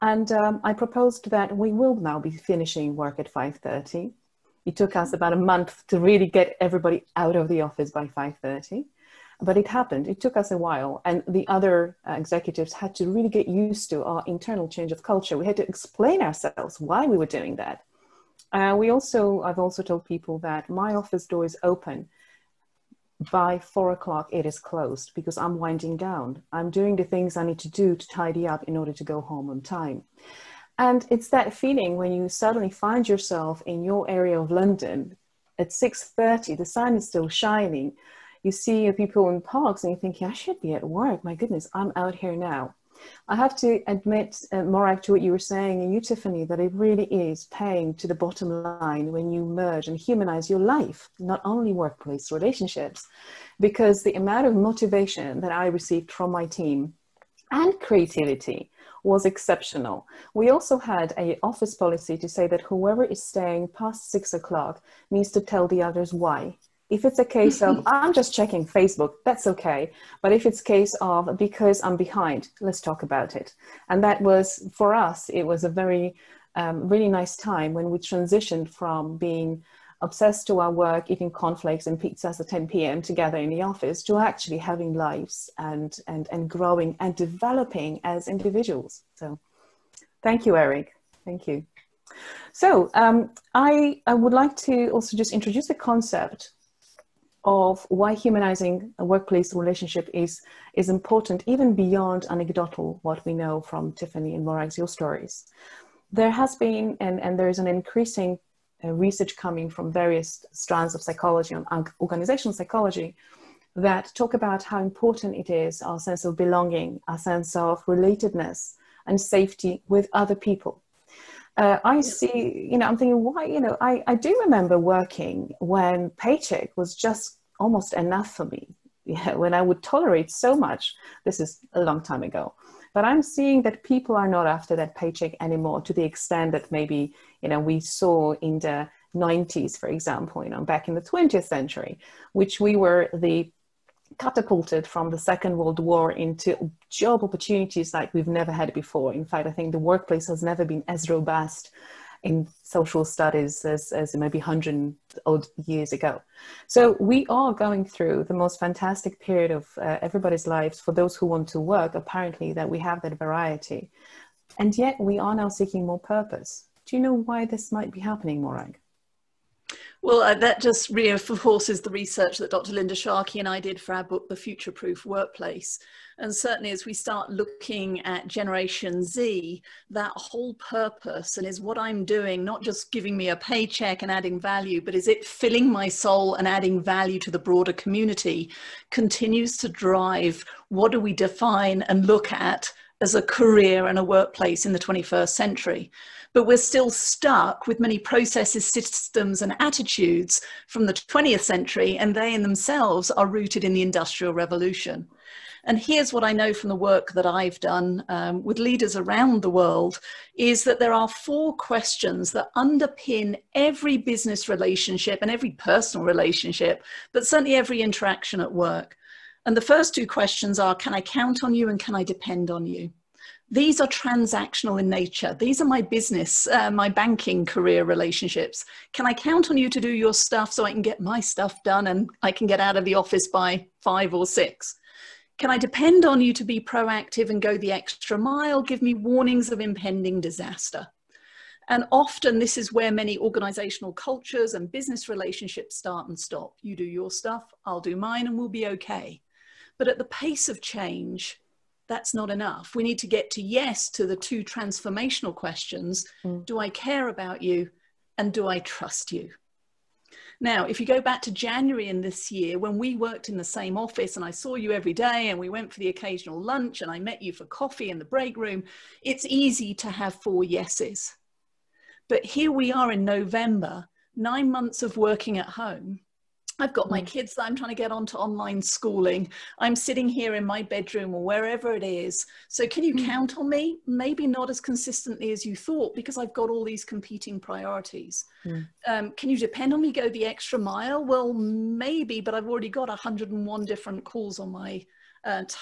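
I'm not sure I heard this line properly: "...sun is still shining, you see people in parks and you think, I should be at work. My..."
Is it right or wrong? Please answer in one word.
right.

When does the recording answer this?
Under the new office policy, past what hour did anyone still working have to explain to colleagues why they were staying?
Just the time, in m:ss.
1:04.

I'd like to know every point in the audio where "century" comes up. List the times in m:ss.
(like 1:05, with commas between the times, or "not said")
2:21, 3:15, 3:21.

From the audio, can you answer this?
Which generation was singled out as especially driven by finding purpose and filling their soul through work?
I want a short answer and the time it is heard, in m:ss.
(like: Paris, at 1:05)
Generation Z, at 2:58.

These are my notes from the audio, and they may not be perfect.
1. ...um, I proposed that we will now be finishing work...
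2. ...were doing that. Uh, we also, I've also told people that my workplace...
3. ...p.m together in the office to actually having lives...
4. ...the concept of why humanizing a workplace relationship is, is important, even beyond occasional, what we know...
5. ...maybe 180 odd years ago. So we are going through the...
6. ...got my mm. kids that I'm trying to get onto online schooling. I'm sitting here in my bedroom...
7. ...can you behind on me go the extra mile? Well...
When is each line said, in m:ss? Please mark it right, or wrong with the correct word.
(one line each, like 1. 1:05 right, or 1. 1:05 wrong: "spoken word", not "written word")
1. 0:00 right
2. 0:17 wrong: "office", not "workplace"
3. 1:22 right
4. 1:35 wrong: "anecdotal", not "occasional"
5. 2:34 wrong: "100", not "180"
6. 4:36 right
7. 4:49 wrong: "depend", not "behind".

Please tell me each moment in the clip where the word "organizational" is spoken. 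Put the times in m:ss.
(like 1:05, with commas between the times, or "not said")
1:52, 4:03.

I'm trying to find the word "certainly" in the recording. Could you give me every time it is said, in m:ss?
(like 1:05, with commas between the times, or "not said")
2:56, 3:37.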